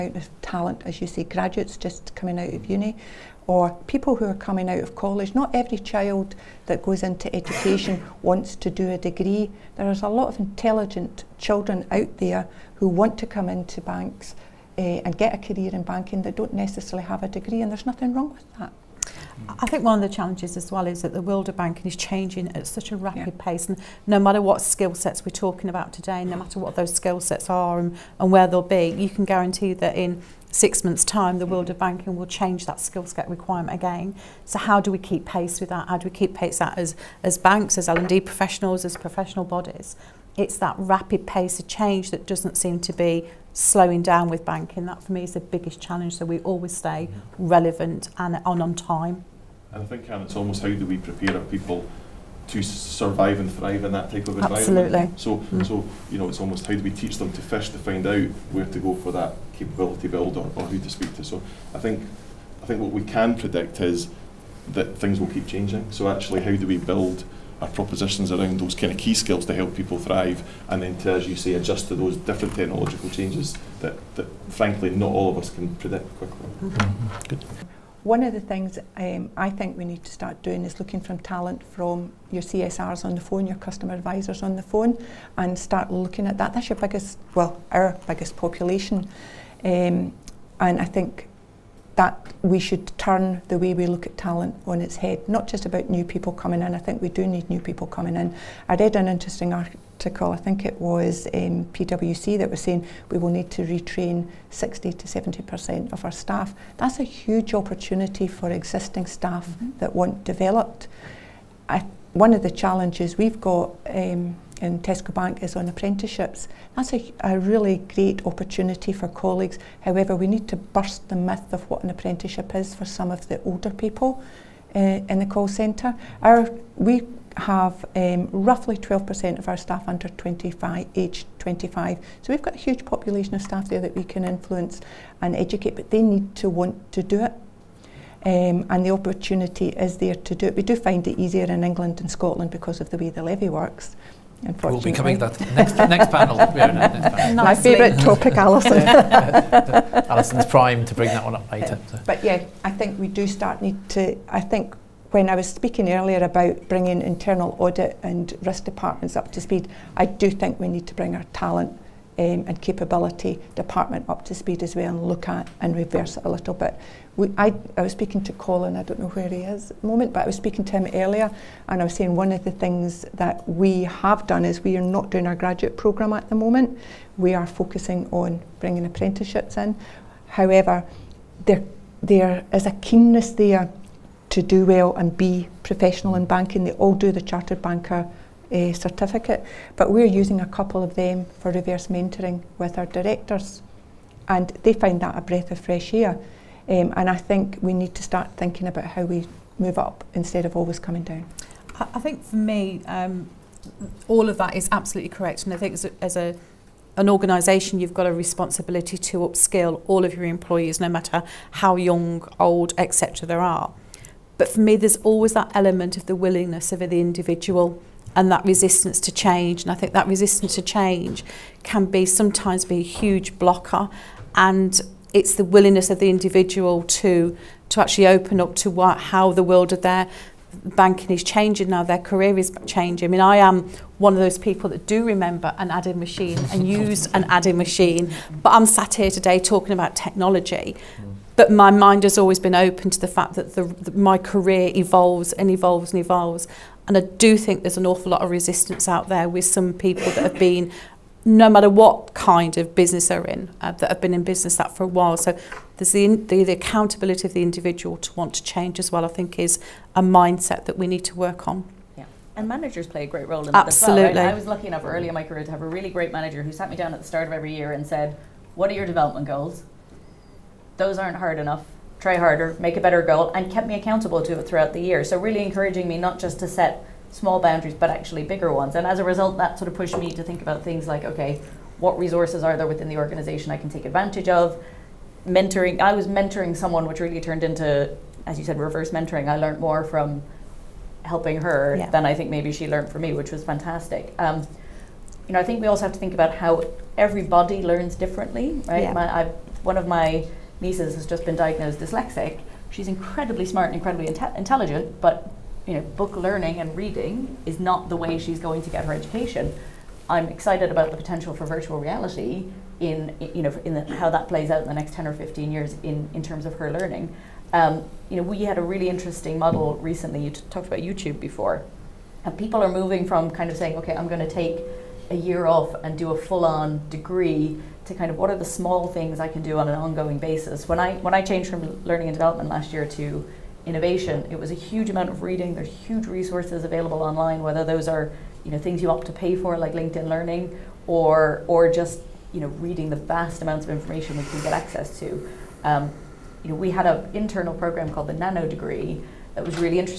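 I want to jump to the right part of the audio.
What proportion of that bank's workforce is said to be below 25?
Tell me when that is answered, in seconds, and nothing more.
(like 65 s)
128 s.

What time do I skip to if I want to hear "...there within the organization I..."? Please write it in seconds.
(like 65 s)
282 s.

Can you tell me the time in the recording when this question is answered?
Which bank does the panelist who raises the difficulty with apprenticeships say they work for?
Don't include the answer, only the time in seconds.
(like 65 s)
114 s.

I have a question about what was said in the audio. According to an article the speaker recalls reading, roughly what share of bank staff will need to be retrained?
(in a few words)
60 to 70%.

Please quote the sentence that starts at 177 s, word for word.
We are focusing on bringing apprenticeships in.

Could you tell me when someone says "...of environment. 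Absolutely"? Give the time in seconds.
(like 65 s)
54 s.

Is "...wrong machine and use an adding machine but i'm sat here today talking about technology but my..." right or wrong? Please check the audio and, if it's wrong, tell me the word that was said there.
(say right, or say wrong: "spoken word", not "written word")
wrong: "adding", not "wrong".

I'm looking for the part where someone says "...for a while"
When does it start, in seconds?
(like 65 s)
254 s.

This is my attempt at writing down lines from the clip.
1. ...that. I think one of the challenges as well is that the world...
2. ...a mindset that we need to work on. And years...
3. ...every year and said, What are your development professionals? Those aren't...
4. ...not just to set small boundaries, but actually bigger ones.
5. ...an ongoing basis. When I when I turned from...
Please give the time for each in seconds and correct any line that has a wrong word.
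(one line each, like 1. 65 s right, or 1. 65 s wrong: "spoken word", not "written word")
1. 18 s right
2. 259 s wrong: "managers", not "years"
3. 267 s wrong: "goals", not "professionals"
4. 275 s right
5. 329 s wrong: "changed", not "turned".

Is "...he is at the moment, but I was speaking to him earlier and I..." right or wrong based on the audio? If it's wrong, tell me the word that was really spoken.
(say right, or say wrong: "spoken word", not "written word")
right.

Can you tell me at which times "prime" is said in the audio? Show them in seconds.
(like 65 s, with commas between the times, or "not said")
150 s.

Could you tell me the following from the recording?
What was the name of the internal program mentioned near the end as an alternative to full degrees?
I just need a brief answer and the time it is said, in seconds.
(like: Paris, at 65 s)
Nano Degree, at 348 s.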